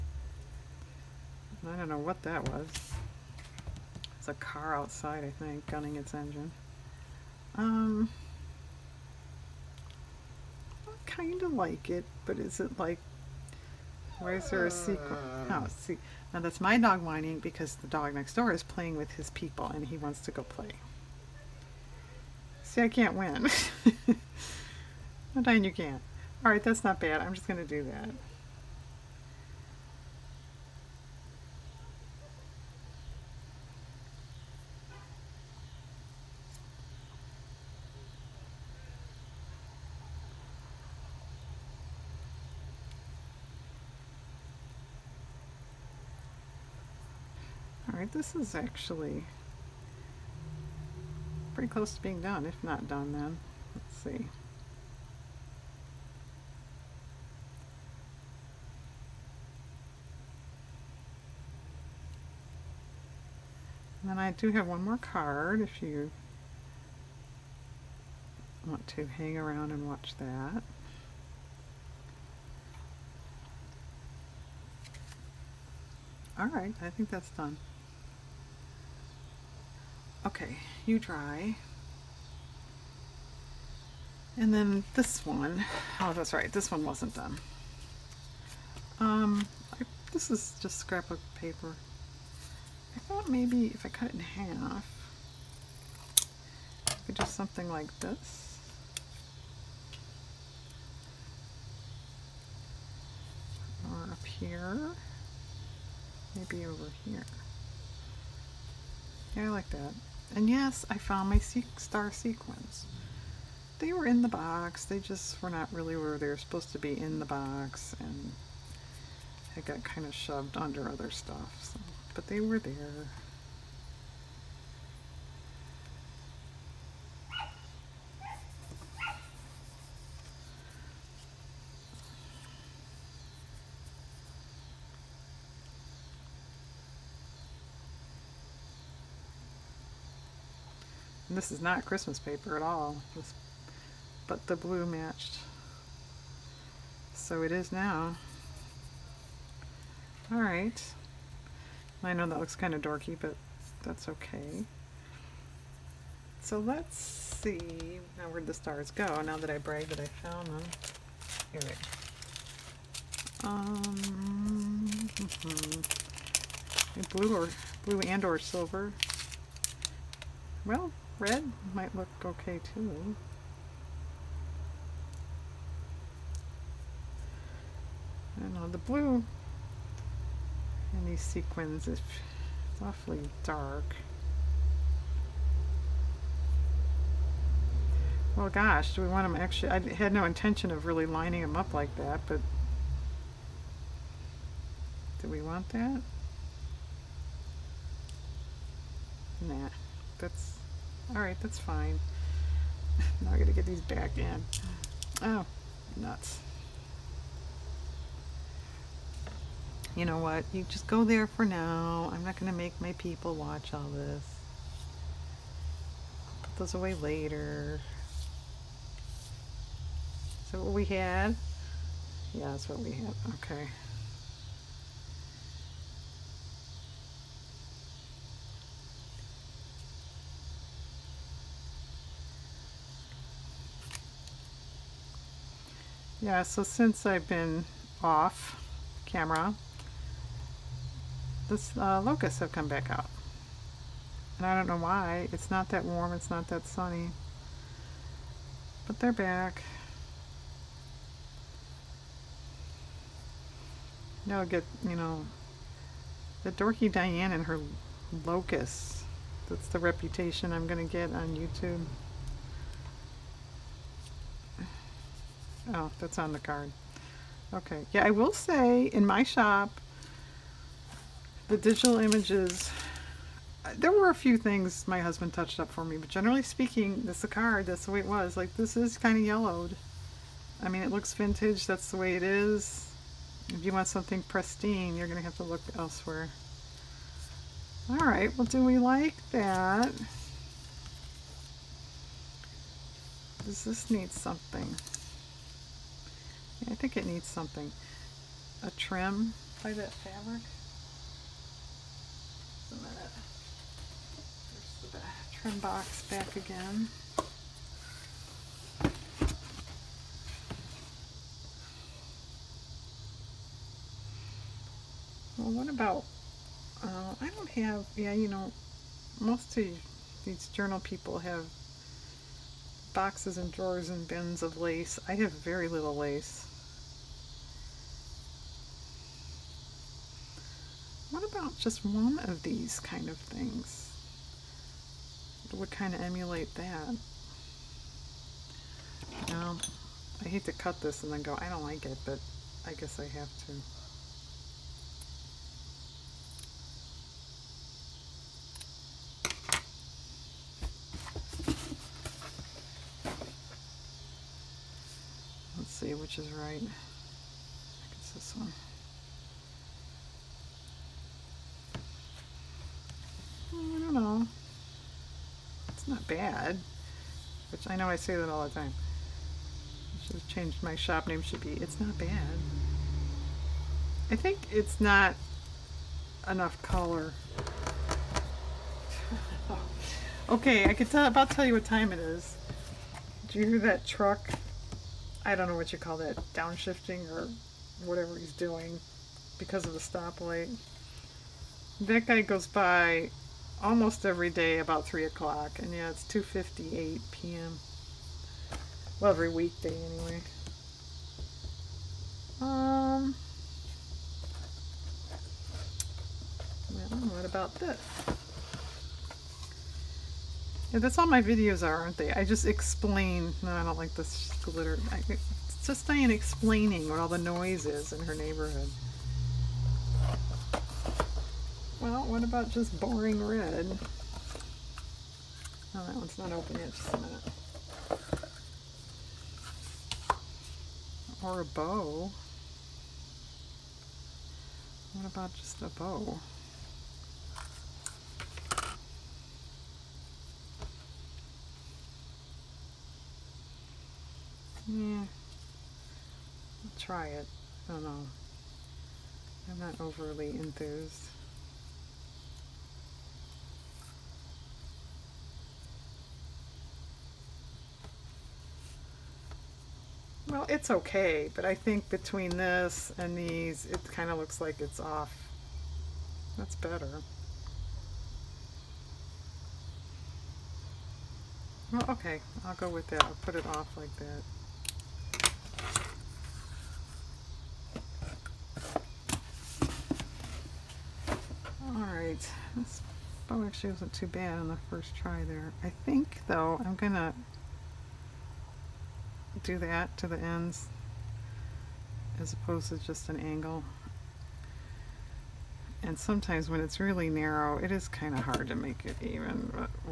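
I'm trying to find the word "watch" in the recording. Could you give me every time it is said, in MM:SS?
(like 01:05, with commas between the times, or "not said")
01:09, 03:33.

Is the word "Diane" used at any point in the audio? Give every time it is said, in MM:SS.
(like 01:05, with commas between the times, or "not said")
04:16, 06:55.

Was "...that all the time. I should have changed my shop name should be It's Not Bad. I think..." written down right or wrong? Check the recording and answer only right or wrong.
right.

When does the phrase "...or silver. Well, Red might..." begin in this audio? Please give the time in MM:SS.
02:48.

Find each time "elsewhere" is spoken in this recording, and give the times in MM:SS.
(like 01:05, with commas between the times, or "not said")
04:45.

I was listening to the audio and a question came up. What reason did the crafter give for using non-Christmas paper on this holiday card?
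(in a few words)
The blue matched.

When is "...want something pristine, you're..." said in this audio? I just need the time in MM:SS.
04:43.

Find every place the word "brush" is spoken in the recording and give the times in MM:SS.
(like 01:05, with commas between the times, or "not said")
not said.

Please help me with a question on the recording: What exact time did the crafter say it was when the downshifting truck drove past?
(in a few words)
2:58 p.m.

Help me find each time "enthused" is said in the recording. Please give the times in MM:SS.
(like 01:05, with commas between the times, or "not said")
07:30.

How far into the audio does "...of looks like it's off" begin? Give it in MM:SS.
07:44.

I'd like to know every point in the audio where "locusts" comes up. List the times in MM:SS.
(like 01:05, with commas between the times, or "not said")
04:02, 04:18.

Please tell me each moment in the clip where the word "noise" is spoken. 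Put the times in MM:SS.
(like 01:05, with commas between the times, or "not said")
06:57.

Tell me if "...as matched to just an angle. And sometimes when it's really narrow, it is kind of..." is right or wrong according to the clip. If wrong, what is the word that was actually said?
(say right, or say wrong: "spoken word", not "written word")
wrong: "opposed", not "matched".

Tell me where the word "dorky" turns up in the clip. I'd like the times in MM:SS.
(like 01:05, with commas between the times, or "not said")
02:32, 04:16.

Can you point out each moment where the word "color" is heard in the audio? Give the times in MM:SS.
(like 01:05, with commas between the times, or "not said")
06:16.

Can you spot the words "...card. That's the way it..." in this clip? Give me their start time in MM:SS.
04:37.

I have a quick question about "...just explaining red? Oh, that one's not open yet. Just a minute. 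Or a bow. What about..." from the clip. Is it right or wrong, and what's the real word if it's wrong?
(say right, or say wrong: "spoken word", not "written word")
wrong: "boring", not "explaining".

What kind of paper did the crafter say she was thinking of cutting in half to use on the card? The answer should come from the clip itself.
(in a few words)
Scrapbook paper.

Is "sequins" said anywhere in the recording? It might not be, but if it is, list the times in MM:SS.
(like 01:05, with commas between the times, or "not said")
00:14, 01:52, 03:01.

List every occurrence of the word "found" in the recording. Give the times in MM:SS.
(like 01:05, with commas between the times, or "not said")
01:50, 02:40.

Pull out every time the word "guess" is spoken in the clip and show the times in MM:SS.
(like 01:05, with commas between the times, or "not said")
05:42.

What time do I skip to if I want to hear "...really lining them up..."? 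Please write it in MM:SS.
03:10.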